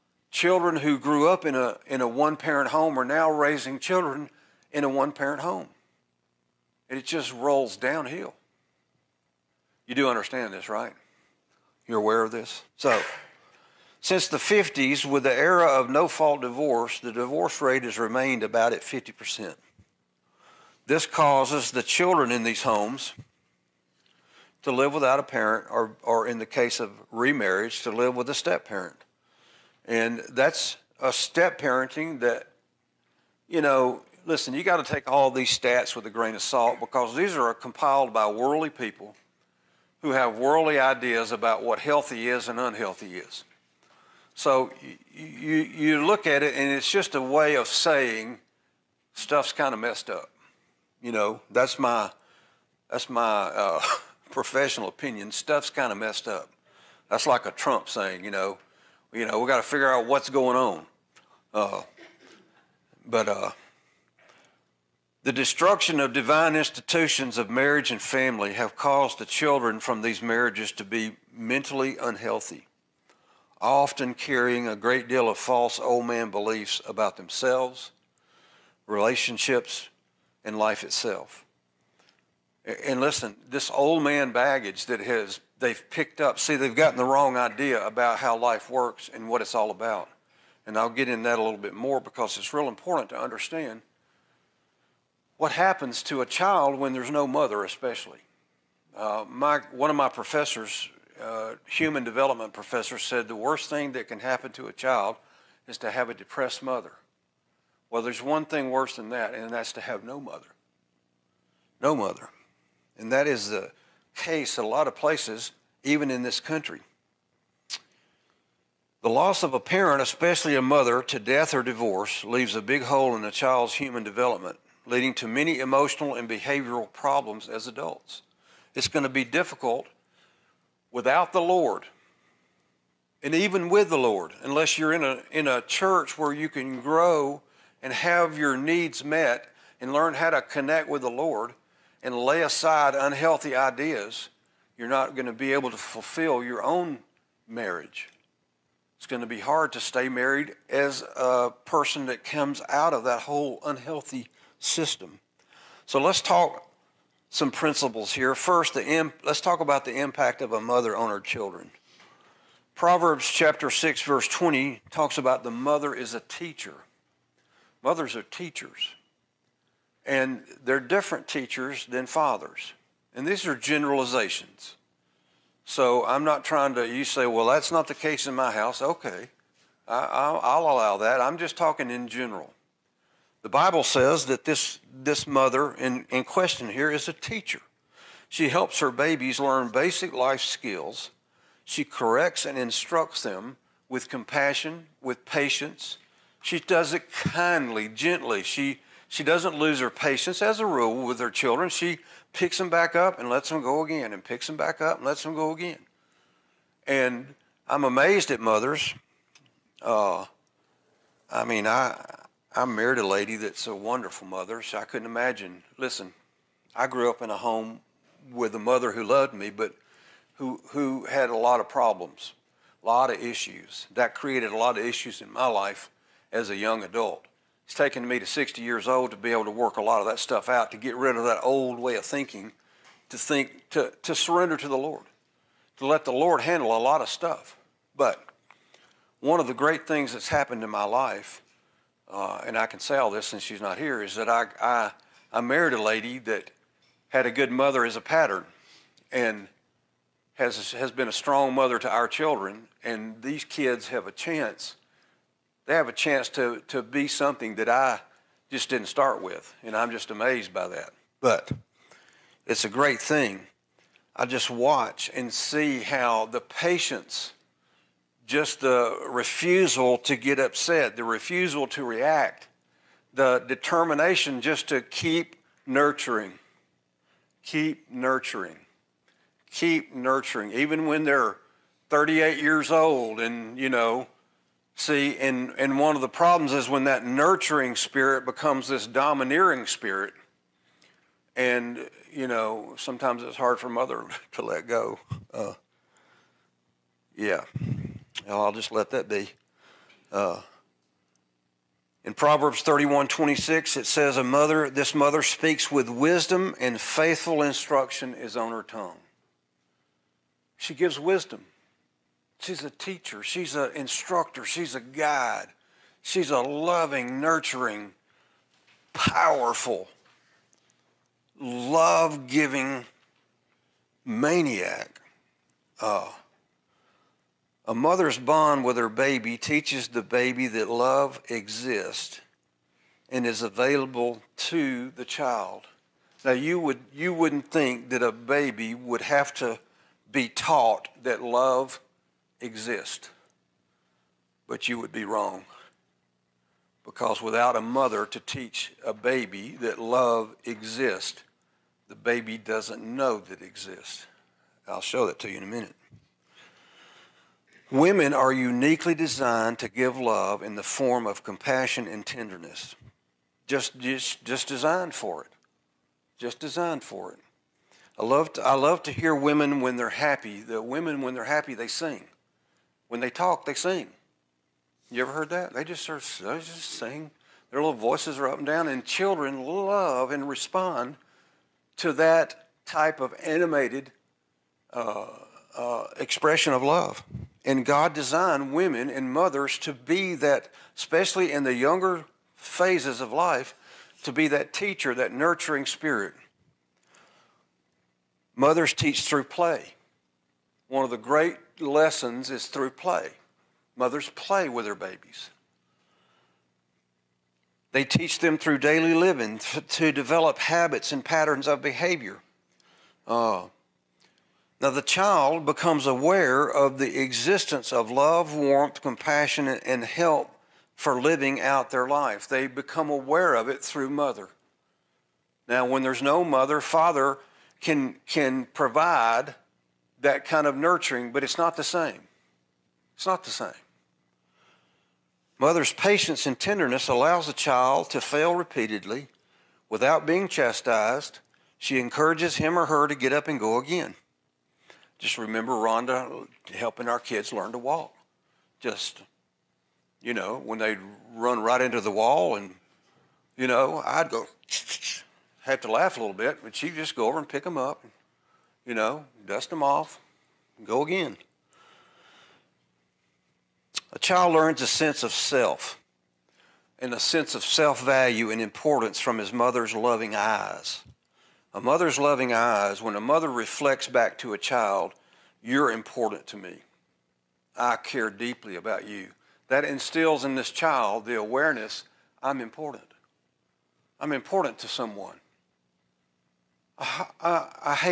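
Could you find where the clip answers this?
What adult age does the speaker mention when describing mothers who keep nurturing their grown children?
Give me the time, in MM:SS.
04:41.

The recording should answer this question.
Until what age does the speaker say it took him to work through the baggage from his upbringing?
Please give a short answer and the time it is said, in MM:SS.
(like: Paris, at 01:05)
60, at 03:48.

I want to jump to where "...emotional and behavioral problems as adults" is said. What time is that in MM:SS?
02:05.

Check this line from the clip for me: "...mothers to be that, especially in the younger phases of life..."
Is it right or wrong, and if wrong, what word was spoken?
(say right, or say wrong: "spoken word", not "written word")
right.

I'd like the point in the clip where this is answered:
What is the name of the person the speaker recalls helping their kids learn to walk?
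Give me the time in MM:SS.
07:25.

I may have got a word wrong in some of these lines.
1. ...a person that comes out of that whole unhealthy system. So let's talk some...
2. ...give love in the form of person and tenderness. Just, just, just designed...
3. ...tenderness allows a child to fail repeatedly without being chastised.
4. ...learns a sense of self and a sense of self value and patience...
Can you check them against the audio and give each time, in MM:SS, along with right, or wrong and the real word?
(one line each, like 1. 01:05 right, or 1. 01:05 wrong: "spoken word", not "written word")
1. 02:31 right
2. 05:59 wrong: "compassion", not "person"
3. 07:16 right
4. 07:44 wrong: "importance", not "patience".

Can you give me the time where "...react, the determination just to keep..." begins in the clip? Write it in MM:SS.
04:31.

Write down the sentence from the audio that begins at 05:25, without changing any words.
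Uh, a mother's bond with her baby teaches the baby that love exists and is available to the child.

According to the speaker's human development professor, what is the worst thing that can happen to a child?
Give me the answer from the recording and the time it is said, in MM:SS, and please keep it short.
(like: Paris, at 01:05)
a depressed mother, at 01:46.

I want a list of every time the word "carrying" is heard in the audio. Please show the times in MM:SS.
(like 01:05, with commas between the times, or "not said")
01:14.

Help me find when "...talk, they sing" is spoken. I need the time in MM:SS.
06:13.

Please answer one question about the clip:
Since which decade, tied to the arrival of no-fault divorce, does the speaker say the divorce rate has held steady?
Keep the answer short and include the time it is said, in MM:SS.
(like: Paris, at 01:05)
1950s, at 00:14.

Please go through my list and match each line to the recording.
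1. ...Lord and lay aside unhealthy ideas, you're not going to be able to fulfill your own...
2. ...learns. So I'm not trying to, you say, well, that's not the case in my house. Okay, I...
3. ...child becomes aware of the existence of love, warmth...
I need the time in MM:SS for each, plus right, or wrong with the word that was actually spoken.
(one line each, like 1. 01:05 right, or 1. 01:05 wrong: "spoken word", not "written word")
1. 02:21 right
2. 02:53 wrong: "generalizations", not "learns"
3. 06:54 right.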